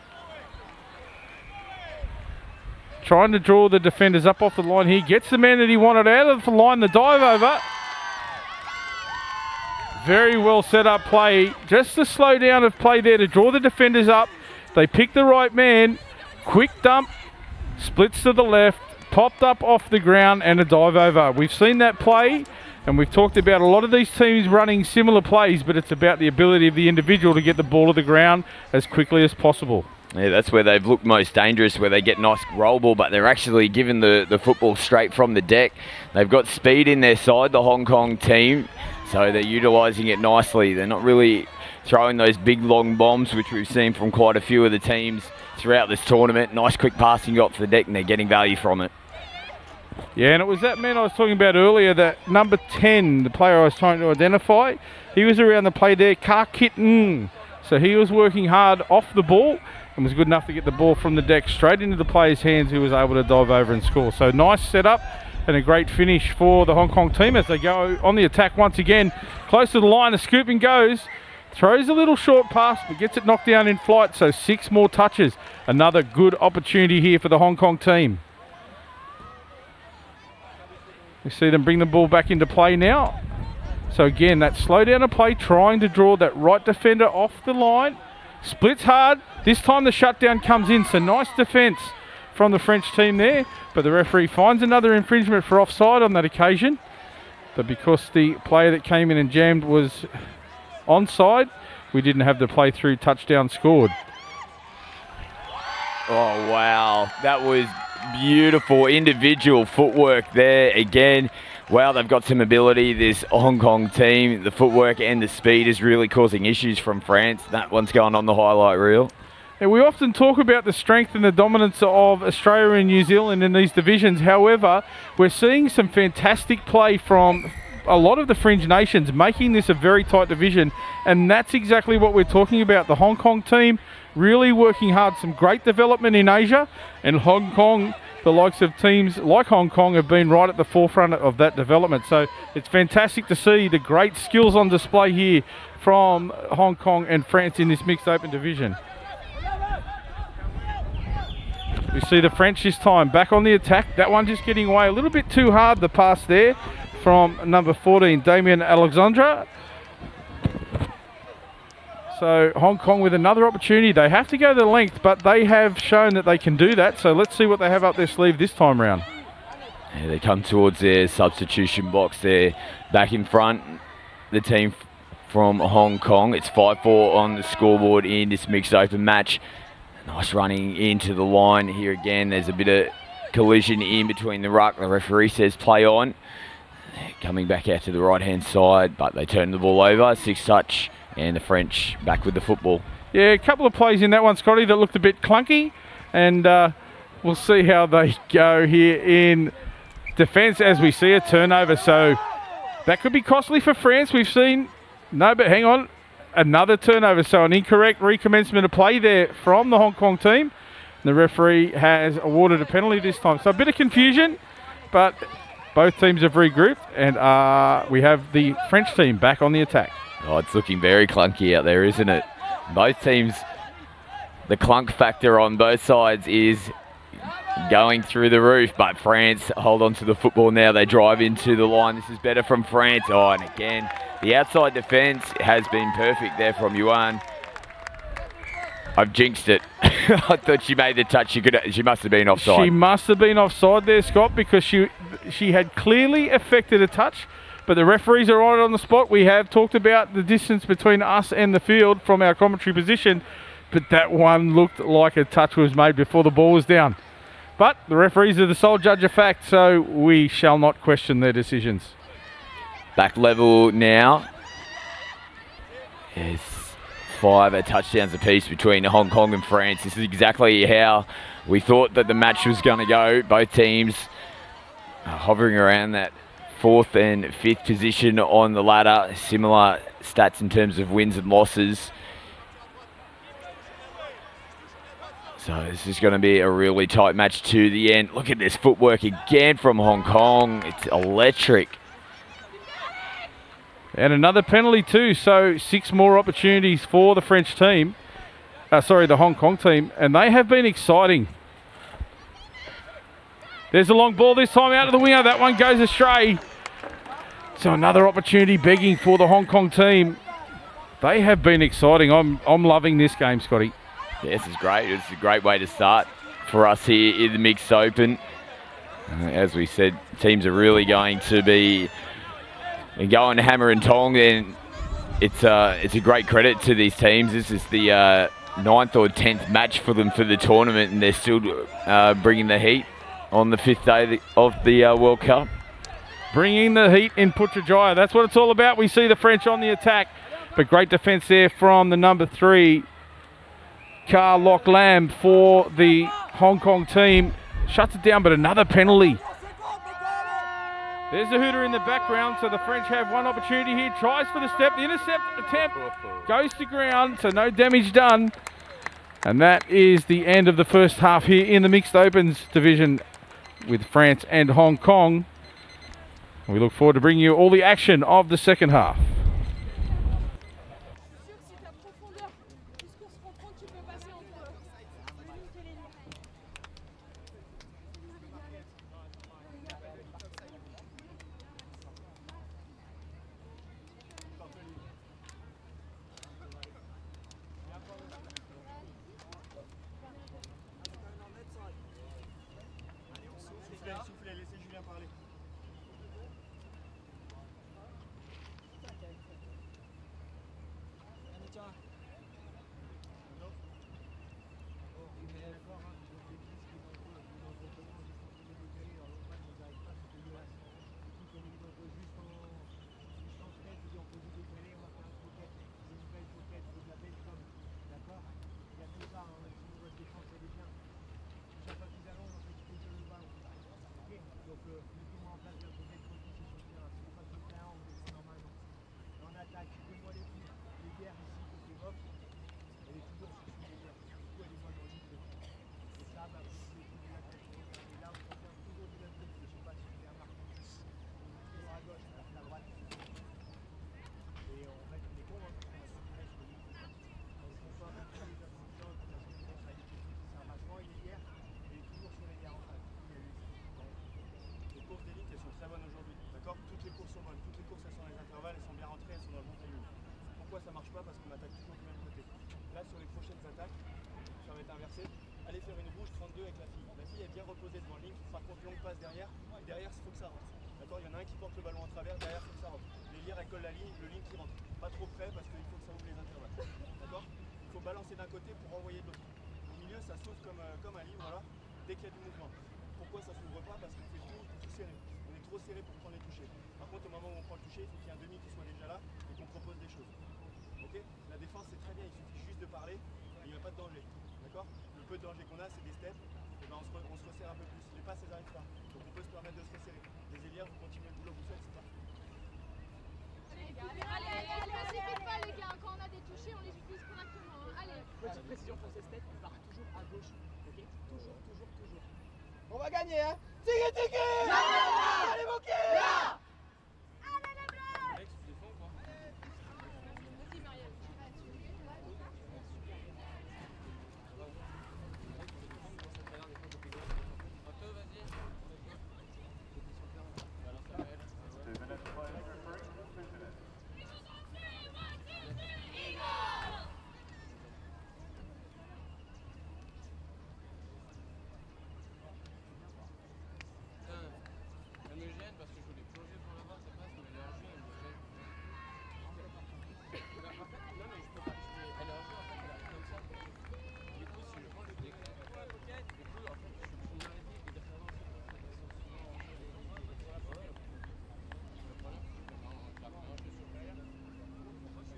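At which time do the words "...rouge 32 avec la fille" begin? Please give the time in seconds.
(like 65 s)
465 s.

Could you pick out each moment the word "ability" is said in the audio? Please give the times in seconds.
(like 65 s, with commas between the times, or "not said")
26 s, 112 s.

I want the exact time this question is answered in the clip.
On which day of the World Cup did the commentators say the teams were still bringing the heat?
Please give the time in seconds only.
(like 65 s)
333 s.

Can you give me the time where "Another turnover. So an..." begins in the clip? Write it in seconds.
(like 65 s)
206 s.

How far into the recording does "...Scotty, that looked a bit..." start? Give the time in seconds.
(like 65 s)
194 s.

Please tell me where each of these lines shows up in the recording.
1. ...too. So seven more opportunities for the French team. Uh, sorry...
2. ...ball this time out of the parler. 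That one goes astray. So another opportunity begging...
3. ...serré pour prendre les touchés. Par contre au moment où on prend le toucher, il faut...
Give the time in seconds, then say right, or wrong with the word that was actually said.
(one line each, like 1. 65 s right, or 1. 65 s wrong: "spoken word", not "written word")
1. 294 s wrong: "six", not "seven"
2. 304 s wrong: "winger", not "parler"
3. 485 s right.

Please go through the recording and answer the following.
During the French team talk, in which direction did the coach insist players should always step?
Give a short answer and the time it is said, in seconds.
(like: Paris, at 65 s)
Left, at 509 s.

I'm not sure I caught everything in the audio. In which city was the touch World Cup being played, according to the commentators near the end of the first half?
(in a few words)
Putrajaya.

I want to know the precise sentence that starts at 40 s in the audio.
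They're not really throwing those big long bombs, which we've seen from quite a few of the teams throughout this tournament.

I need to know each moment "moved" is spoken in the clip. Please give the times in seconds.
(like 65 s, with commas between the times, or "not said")
not said.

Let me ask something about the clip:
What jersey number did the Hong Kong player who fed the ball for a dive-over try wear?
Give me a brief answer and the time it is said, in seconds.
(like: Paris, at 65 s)
10, at 52 s.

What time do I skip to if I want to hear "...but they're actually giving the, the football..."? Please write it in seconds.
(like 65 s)
32 s.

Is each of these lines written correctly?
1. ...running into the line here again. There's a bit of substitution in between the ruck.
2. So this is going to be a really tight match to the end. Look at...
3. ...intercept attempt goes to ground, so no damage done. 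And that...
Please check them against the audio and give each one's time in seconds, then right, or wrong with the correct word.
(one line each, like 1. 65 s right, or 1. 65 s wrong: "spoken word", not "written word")
1. 180 s wrong: "collision", not "substitution"
2. 285 s right
3. 354 s right.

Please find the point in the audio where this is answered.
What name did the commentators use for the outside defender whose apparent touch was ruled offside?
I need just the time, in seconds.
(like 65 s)
236 s.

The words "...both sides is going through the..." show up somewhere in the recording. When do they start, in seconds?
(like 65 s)
225 s.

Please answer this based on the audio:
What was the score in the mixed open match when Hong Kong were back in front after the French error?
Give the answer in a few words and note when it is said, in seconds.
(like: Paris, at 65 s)
5-4, at 176 s.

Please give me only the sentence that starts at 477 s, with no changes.
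D'accord Il faut balancer d'un côté pour envoyer de l'autre.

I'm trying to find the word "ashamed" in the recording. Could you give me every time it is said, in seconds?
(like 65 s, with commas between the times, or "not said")
not said.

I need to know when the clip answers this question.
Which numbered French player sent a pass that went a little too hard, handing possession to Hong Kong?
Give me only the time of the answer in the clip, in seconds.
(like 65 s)
157 s.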